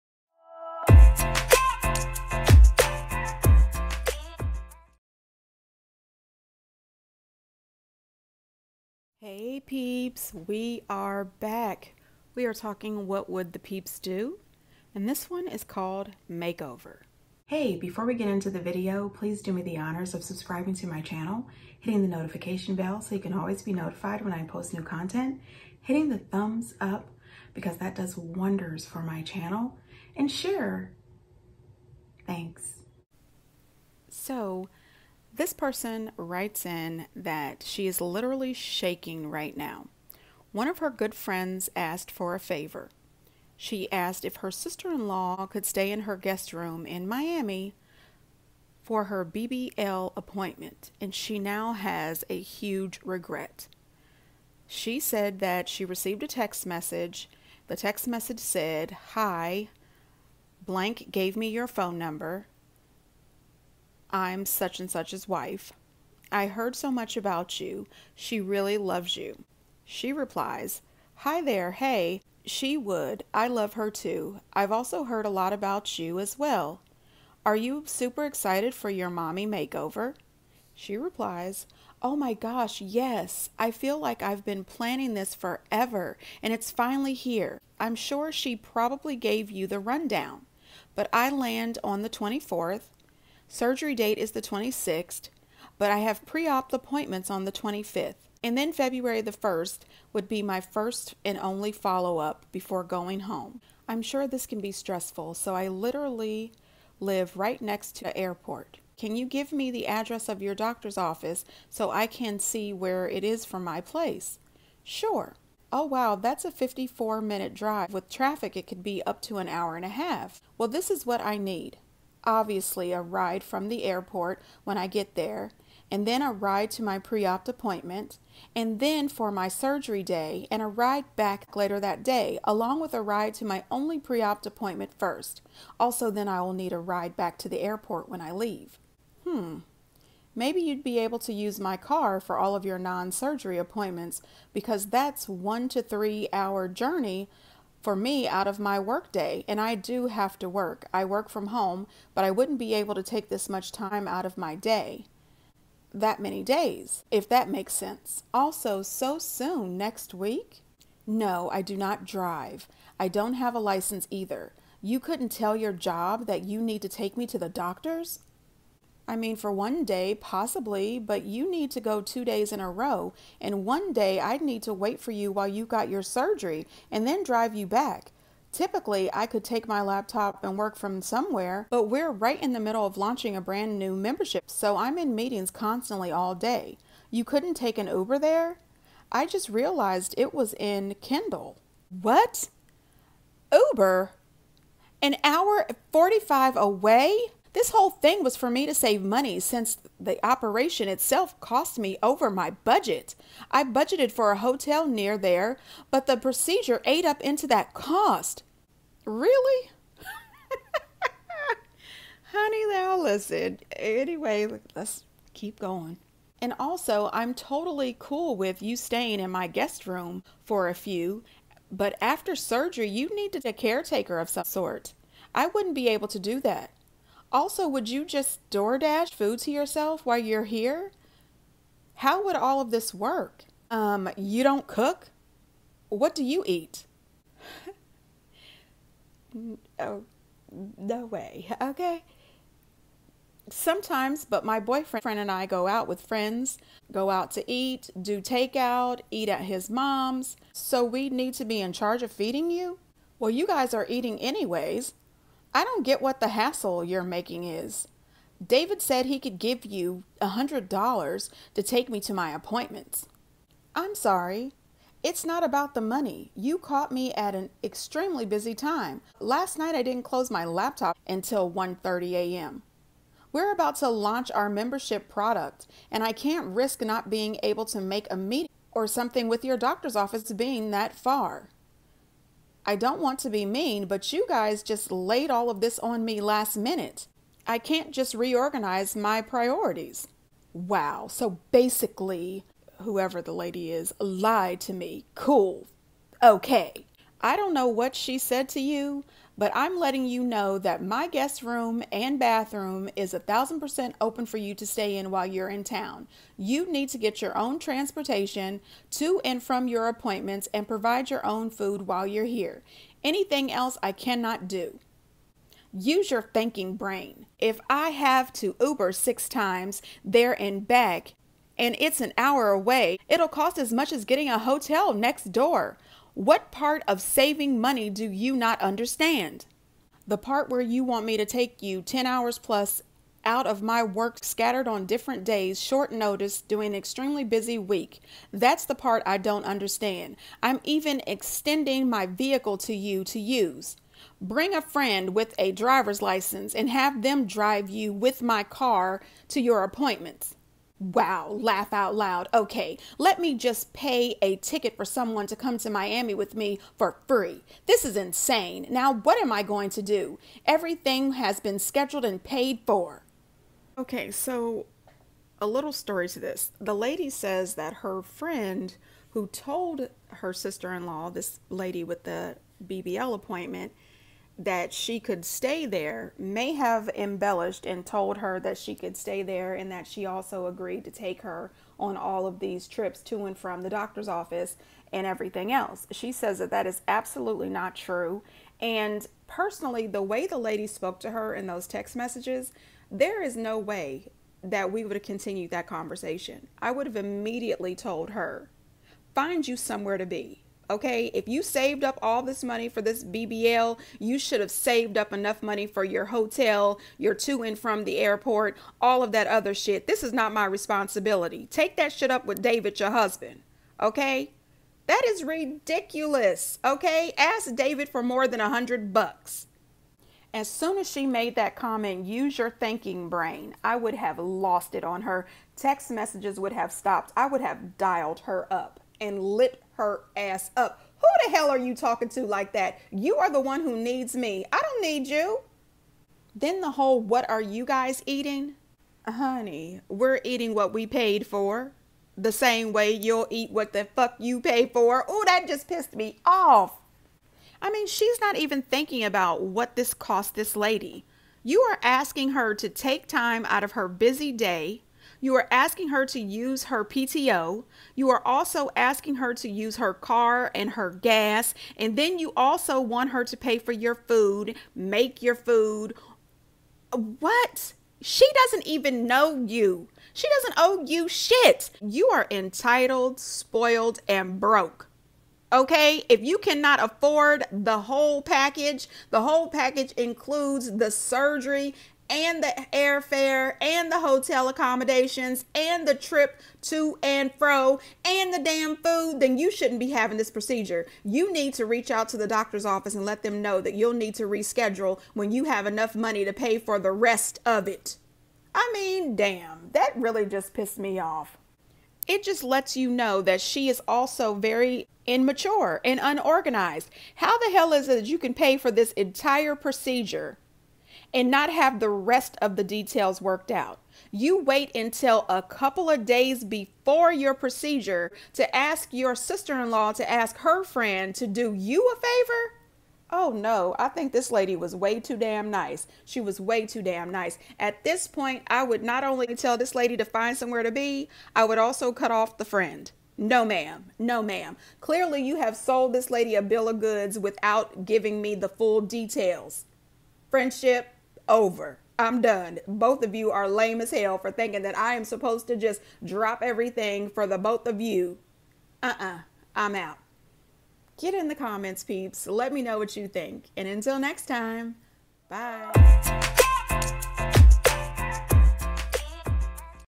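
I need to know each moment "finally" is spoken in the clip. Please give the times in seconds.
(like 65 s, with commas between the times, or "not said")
86 s.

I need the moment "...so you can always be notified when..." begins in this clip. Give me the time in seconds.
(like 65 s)
22 s.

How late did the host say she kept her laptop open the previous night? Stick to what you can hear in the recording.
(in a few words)
1:30 a.m.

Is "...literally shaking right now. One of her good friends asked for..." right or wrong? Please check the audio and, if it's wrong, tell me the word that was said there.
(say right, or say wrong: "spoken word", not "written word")
right.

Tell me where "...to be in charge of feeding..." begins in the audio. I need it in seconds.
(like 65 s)
251 s.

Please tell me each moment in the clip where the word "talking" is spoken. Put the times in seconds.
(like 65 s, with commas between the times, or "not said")
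12 s, 431 s.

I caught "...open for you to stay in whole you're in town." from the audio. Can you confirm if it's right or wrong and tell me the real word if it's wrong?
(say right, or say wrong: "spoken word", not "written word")
wrong: "while", not "whole".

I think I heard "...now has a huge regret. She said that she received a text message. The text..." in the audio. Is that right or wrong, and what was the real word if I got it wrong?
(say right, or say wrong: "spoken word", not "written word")
right.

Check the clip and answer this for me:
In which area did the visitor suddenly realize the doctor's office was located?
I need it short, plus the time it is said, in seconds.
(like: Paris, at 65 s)
Kendall, at 191 s.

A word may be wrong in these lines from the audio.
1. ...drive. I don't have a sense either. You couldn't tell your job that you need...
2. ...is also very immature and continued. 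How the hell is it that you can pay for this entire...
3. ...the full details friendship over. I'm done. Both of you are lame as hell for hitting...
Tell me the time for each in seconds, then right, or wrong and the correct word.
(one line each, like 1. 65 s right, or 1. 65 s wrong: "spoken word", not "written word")
1. 162 s wrong: "license", not "sense"
2. 503 s wrong: "unorganized", not "continued"
3. 538 s wrong: "thinking", not "hitting".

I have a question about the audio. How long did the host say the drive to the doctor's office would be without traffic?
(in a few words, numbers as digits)
54 minutes.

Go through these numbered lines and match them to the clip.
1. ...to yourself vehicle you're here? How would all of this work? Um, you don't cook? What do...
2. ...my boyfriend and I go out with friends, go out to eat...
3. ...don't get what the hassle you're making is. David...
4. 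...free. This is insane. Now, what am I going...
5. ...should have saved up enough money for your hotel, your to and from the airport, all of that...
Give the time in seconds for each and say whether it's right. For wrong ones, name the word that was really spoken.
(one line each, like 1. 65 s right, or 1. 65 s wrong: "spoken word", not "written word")
1. 229 s wrong: "while", not "vehicle"
2. 244 s right
3. 255 s right
4. 357 s right
5. 404 s right.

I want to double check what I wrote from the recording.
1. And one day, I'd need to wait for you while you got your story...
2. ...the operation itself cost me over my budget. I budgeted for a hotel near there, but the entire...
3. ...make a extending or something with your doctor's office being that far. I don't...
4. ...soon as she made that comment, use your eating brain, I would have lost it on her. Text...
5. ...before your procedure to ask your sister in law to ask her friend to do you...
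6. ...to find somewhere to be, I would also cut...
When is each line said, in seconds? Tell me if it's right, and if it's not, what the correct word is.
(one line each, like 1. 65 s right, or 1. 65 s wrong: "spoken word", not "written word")
1. 173 s wrong: "surgery", not "story"
2. 199 s wrong: "procedure", not "entire"
3. 277 s wrong: "meeting", not "extending"
4. 420 s wrong: "thinking", not "eating"
5. 516 s right
6. 529 s right.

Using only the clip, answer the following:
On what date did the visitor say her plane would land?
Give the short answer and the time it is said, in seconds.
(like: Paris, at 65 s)
the 24th, at 92 s.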